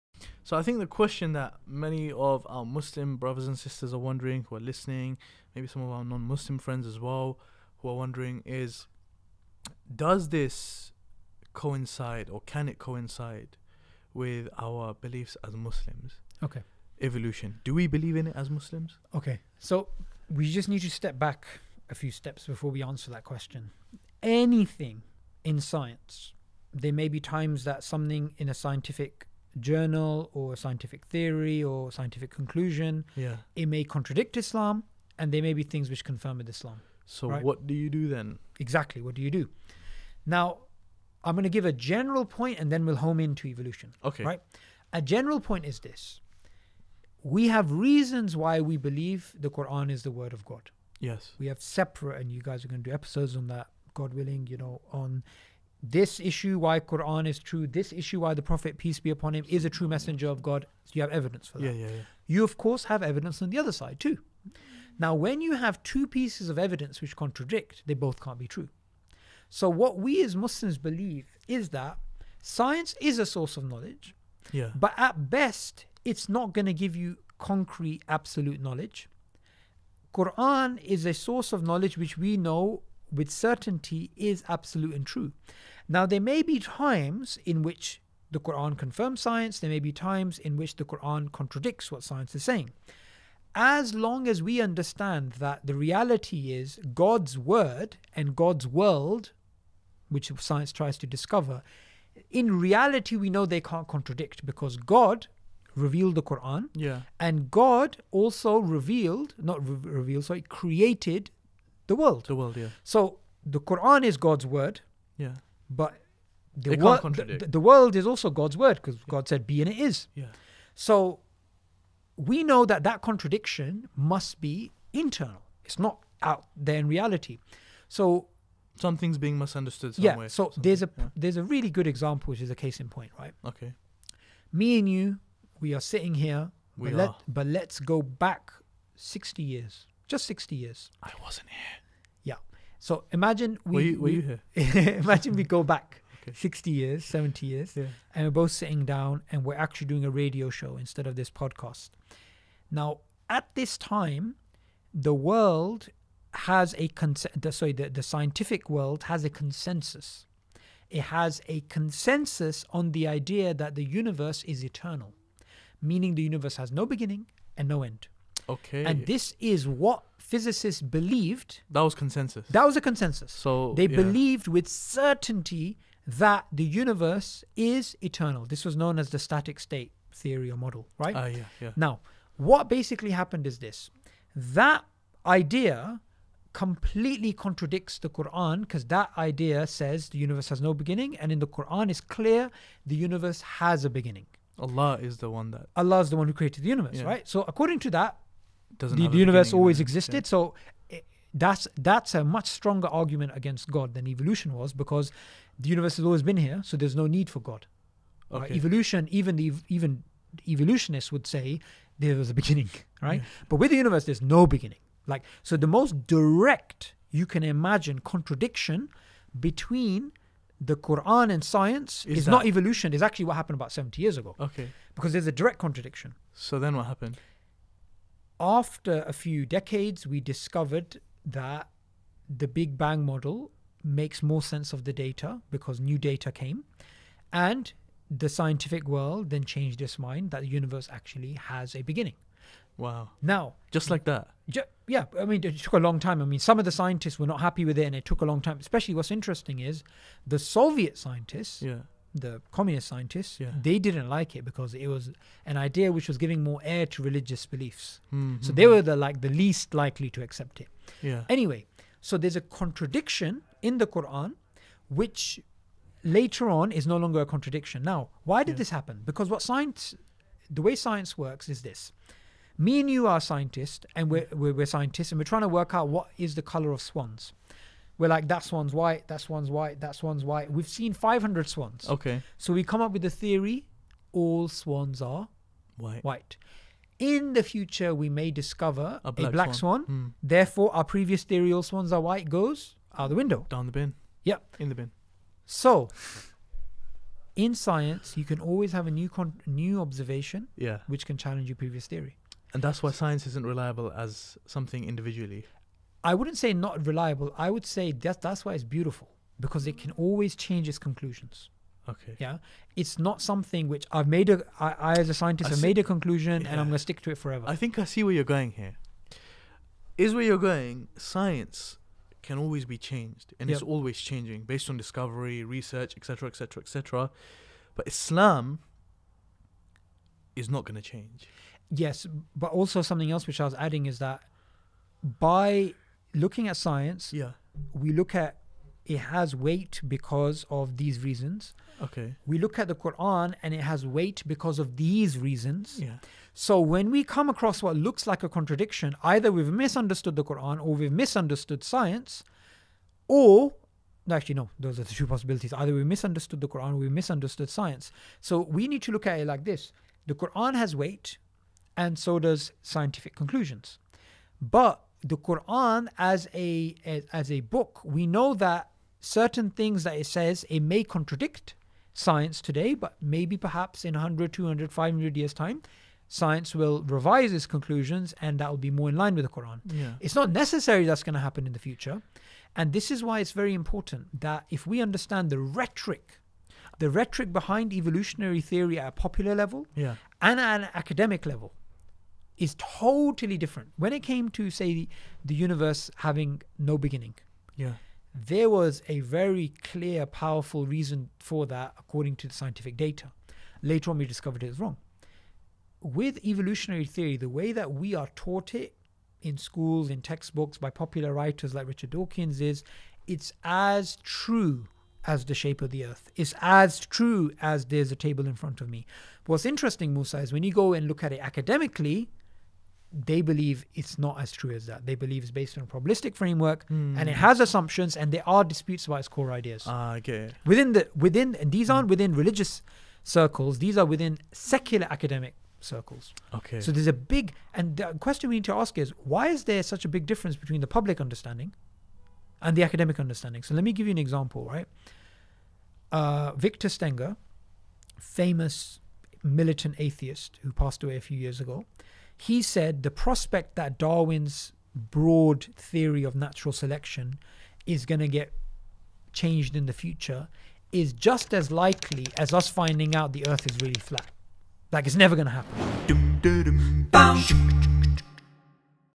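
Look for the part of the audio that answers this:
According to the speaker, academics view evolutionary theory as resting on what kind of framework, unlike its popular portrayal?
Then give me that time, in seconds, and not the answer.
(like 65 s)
425 s.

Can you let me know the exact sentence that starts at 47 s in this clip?
We have reasons why we believe the Quran is the word of God.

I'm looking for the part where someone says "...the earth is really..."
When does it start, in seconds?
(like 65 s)
463 s.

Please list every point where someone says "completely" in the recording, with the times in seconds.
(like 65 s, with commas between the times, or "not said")
186 s.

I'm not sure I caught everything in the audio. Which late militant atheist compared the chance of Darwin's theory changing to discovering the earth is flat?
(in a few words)
Victor Stenger.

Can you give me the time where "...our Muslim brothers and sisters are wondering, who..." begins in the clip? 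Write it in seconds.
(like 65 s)
2 s.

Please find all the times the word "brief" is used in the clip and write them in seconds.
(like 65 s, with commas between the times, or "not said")
not said.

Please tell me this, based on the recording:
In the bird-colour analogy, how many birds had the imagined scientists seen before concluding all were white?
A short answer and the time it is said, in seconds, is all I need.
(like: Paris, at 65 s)
500, at 280 s.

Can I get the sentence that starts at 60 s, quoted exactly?
So you have evidence for that.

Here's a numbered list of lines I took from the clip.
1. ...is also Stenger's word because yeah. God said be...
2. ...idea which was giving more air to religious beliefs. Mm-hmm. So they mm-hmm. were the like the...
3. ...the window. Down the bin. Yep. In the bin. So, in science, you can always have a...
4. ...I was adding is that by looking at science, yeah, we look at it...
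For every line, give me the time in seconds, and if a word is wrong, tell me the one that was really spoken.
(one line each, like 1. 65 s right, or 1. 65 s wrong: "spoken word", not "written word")
1. 117 s wrong: "God", not "Stenger"
2. 255 s right
3. 293 s right
4. 333 s right.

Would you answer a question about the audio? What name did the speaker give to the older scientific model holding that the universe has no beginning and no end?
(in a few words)
static state theory.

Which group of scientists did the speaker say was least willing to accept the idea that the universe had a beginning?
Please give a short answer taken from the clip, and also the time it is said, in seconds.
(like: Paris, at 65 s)
Soviet scientists, at 250 s.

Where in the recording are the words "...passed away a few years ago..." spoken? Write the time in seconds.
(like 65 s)
450 s.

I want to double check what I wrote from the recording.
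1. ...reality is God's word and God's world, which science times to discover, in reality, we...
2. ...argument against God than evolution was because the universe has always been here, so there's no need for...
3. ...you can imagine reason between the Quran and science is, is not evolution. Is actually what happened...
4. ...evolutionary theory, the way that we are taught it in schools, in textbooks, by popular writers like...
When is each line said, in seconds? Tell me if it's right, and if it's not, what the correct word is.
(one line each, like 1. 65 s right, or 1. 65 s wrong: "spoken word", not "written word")
1. 95 s wrong: "tries", not "times"
2. 202 s right
3. 217 s wrong: "contradiction", not "reason"
4. 406 s right.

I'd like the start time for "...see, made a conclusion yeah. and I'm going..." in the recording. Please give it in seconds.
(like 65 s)
315 s.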